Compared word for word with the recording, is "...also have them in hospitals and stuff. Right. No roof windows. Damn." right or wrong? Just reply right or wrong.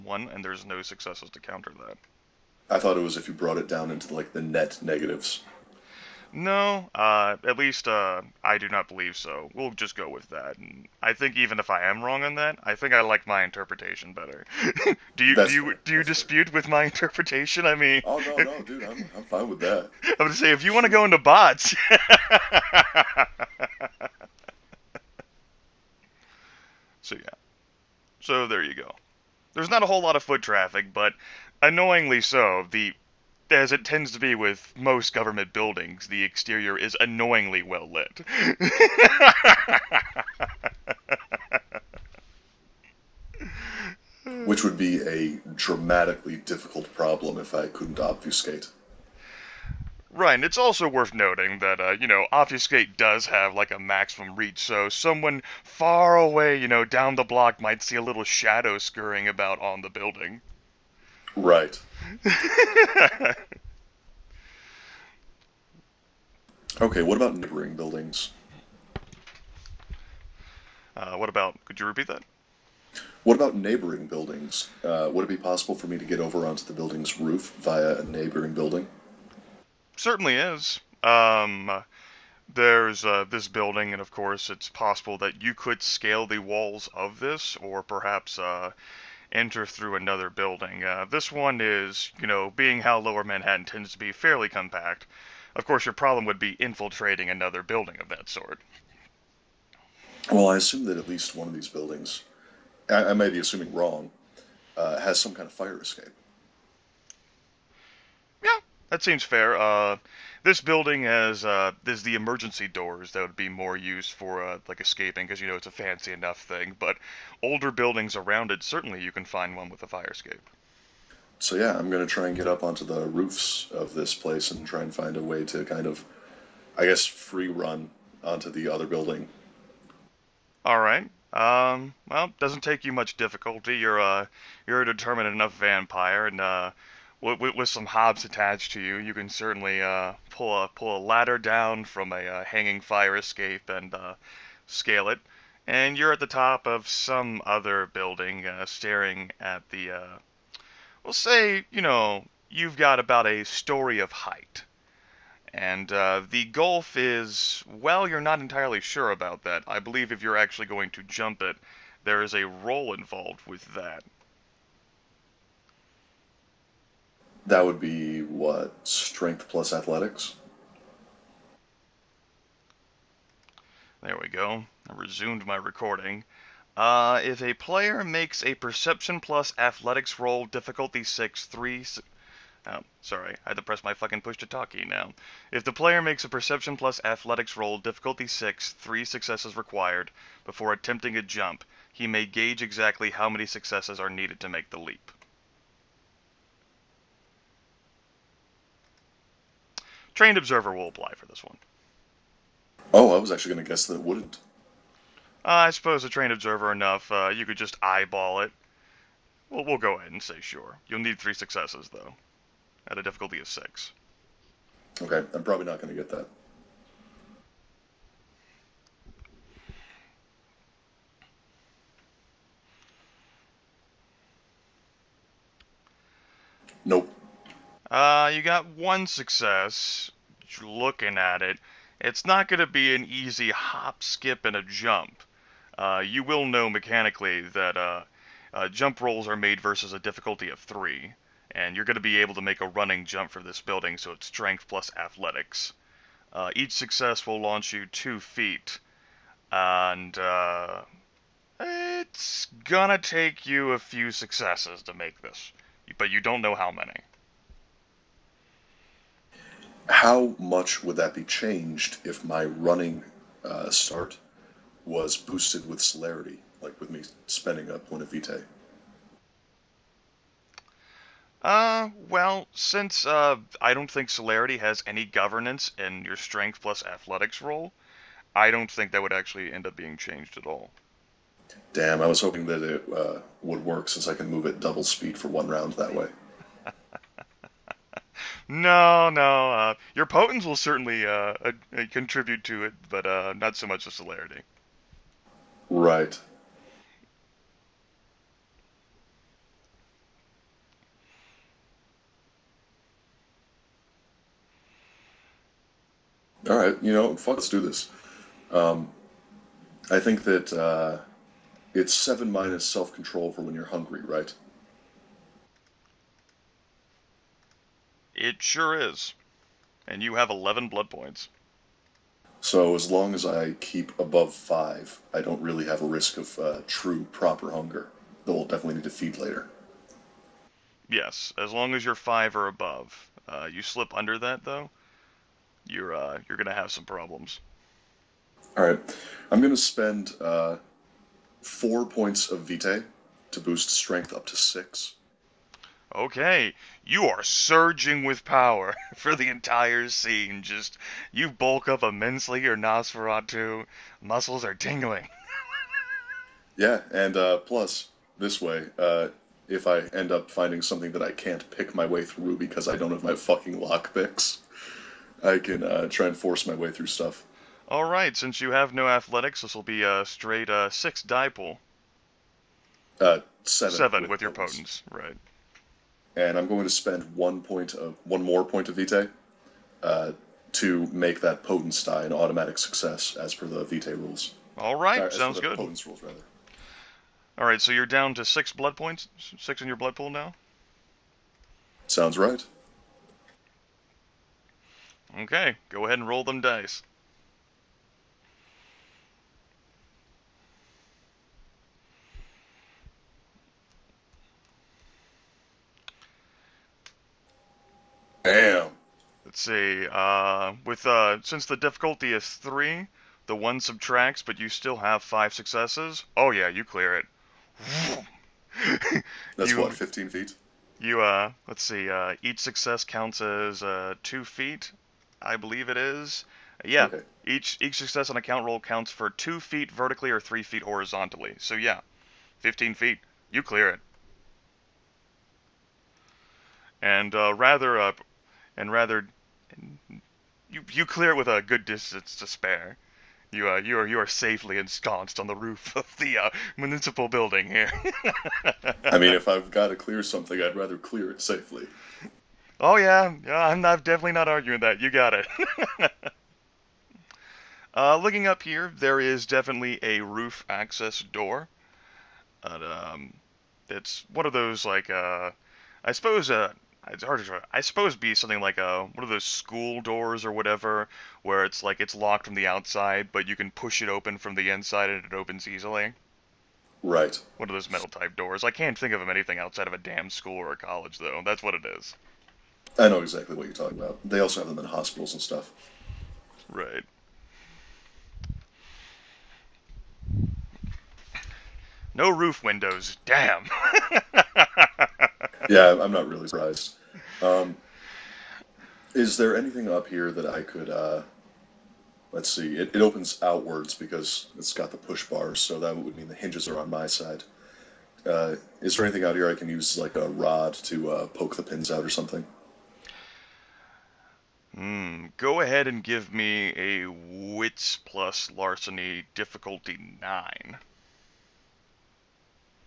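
right.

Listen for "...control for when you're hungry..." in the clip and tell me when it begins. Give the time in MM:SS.
05:12.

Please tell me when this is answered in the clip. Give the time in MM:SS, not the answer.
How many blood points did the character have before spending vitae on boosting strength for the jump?
05:20.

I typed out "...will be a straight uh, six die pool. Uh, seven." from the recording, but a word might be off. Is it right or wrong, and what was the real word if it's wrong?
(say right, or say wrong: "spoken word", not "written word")
right.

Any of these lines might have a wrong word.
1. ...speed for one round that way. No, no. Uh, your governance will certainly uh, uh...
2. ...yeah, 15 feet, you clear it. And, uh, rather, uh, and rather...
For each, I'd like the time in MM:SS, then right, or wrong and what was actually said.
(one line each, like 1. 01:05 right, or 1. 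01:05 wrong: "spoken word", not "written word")
1. 04:44 wrong: "potence", not "governance"
2. 07:11 right.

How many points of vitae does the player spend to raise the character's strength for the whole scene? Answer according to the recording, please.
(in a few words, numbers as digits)
4.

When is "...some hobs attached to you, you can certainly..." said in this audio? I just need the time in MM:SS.
02:17.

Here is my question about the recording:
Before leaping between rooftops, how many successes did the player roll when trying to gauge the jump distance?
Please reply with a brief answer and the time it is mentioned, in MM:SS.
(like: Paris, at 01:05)
1, at 03:48.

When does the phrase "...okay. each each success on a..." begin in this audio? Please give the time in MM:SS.
07:06.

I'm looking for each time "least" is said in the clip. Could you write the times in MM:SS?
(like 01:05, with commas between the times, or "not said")
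00:07, 01:41.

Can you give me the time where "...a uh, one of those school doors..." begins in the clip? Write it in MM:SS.
07:48.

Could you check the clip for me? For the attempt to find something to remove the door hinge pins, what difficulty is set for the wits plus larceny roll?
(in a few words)
9.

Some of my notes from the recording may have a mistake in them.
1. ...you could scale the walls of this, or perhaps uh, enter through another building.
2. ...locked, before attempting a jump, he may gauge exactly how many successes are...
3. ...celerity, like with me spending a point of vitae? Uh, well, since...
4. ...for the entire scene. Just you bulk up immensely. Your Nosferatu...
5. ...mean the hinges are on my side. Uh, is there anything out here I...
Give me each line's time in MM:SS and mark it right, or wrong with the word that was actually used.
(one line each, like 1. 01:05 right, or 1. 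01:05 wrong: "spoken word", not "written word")
1. 01:25 right
2. 03:09 wrong: "required", not "locked"
3. 04:25 right
4. 05:48 right
5. 08:25 right.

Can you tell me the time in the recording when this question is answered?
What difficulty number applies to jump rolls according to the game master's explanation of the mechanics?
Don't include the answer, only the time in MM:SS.
03:59.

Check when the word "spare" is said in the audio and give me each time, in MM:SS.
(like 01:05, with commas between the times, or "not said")
07:22.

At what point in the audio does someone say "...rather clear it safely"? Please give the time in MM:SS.
07:30.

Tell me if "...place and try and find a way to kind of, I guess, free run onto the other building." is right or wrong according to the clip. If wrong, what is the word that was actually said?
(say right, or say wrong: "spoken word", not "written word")
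right.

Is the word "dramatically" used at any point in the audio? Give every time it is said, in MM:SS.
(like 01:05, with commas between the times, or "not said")
00:45.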